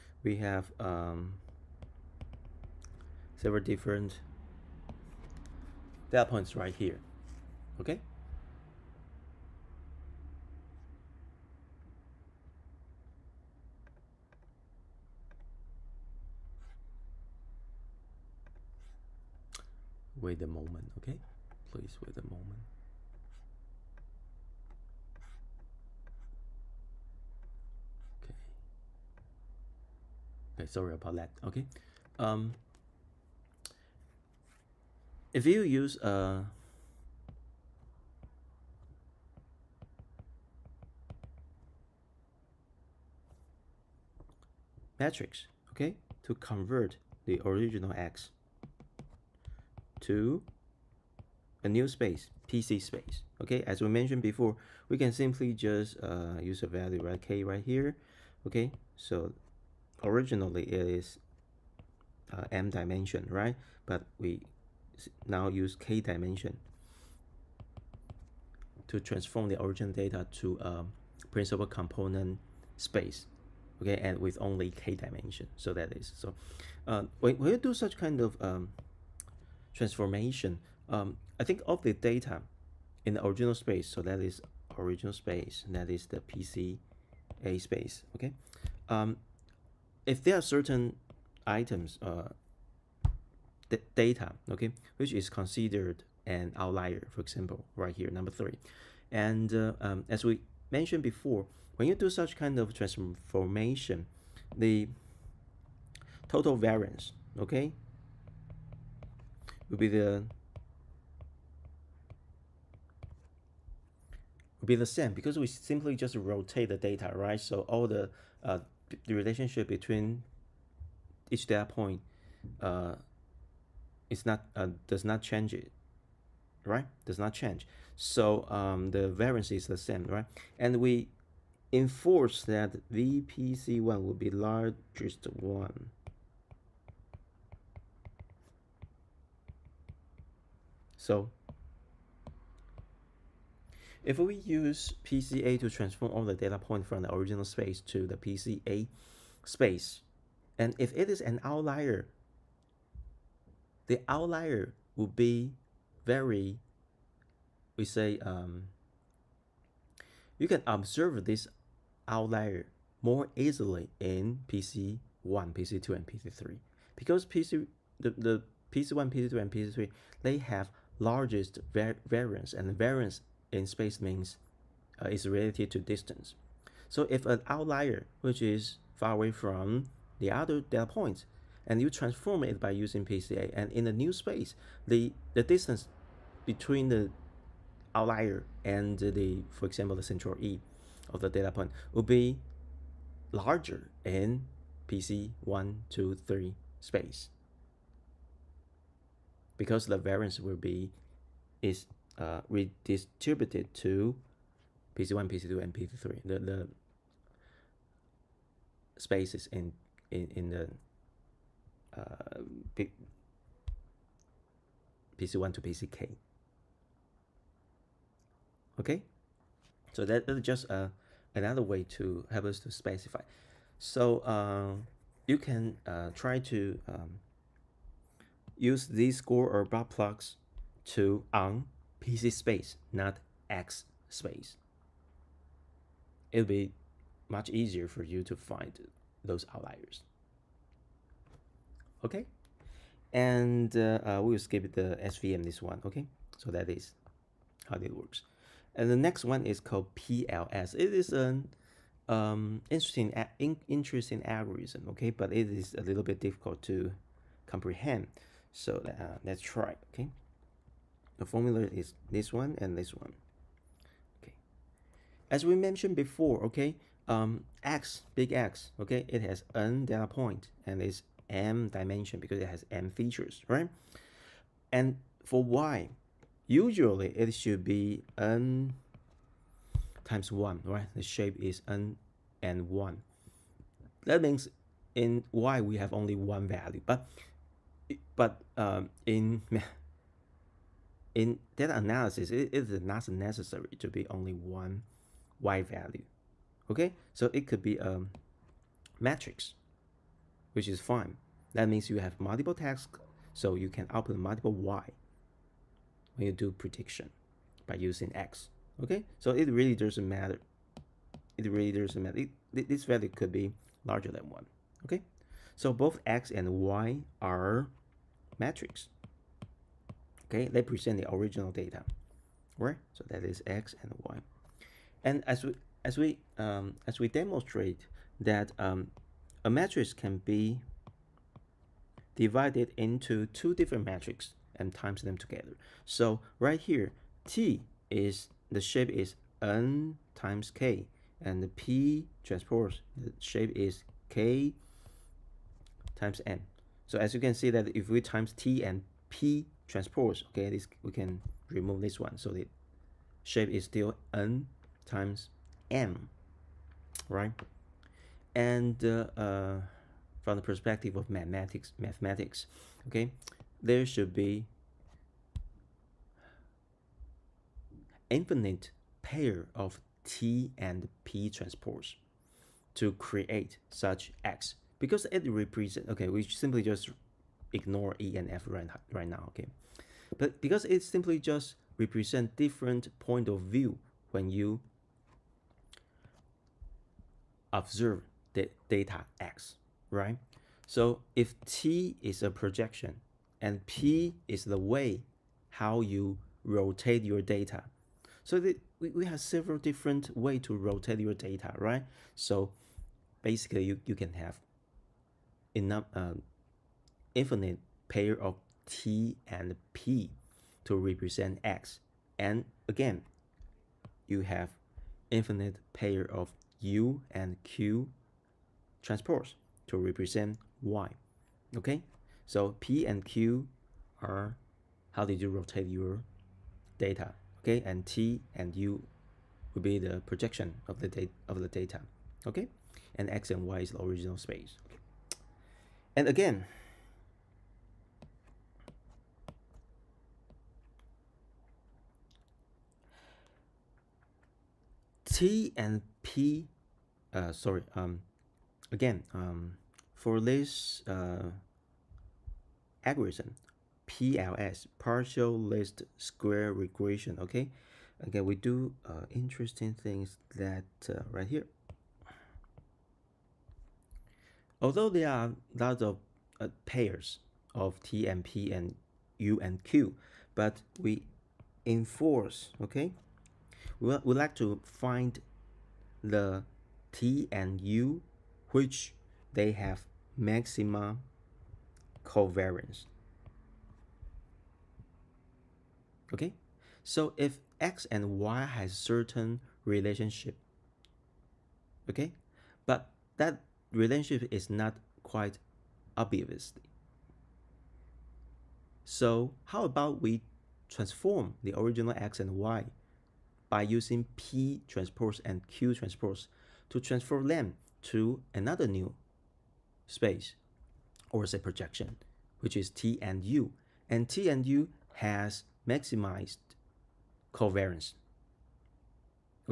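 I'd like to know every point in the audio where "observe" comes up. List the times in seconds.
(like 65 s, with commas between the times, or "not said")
160 s, 387 s.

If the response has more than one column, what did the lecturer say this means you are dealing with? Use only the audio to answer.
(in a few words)
multiple tasks.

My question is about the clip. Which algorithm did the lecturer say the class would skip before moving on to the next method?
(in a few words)
SVM.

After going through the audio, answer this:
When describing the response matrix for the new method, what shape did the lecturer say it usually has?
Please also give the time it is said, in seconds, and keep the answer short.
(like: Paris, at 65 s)
n times 1, at 278 s.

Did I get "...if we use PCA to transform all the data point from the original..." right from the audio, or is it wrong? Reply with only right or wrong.
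right.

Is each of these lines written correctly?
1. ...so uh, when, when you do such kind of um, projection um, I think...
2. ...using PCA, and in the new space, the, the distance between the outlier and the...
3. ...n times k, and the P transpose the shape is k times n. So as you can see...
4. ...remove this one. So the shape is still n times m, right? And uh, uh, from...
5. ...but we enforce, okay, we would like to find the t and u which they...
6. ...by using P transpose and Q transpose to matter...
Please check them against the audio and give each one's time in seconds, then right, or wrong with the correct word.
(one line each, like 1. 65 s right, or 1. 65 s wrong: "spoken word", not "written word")
1. 76 s wrong: "transformation", not "projection"
2. 182 s right
3. 339 s right
4. 351 s right
5. 470 s right
6. 503 s wrong: "transfer", not "matter".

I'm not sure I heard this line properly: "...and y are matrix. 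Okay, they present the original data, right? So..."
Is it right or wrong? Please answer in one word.
right.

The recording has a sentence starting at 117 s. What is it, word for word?
So all the uh, the relationship between each data point uh, is not uh, does not change it, right?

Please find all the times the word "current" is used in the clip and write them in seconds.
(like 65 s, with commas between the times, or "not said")
not said.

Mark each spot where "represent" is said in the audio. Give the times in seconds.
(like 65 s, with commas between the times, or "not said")
375 s, 381 s, 410 s, 419 s.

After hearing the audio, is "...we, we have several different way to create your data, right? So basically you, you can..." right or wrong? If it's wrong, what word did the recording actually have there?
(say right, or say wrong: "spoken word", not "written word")
wrong: "rotate", not "create".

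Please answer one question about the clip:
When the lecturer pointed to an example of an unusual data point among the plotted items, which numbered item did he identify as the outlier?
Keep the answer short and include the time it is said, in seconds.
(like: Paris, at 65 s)
3, at 98 s.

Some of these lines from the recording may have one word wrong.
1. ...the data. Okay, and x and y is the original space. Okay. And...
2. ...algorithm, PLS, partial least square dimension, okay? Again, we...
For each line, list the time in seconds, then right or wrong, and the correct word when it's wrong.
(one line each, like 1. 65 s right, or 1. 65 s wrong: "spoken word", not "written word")
1. 431 s right
2. 452 s wrong: "regression", not "dimension".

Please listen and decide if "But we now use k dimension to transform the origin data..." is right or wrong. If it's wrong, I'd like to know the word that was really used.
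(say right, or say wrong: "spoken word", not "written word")
right.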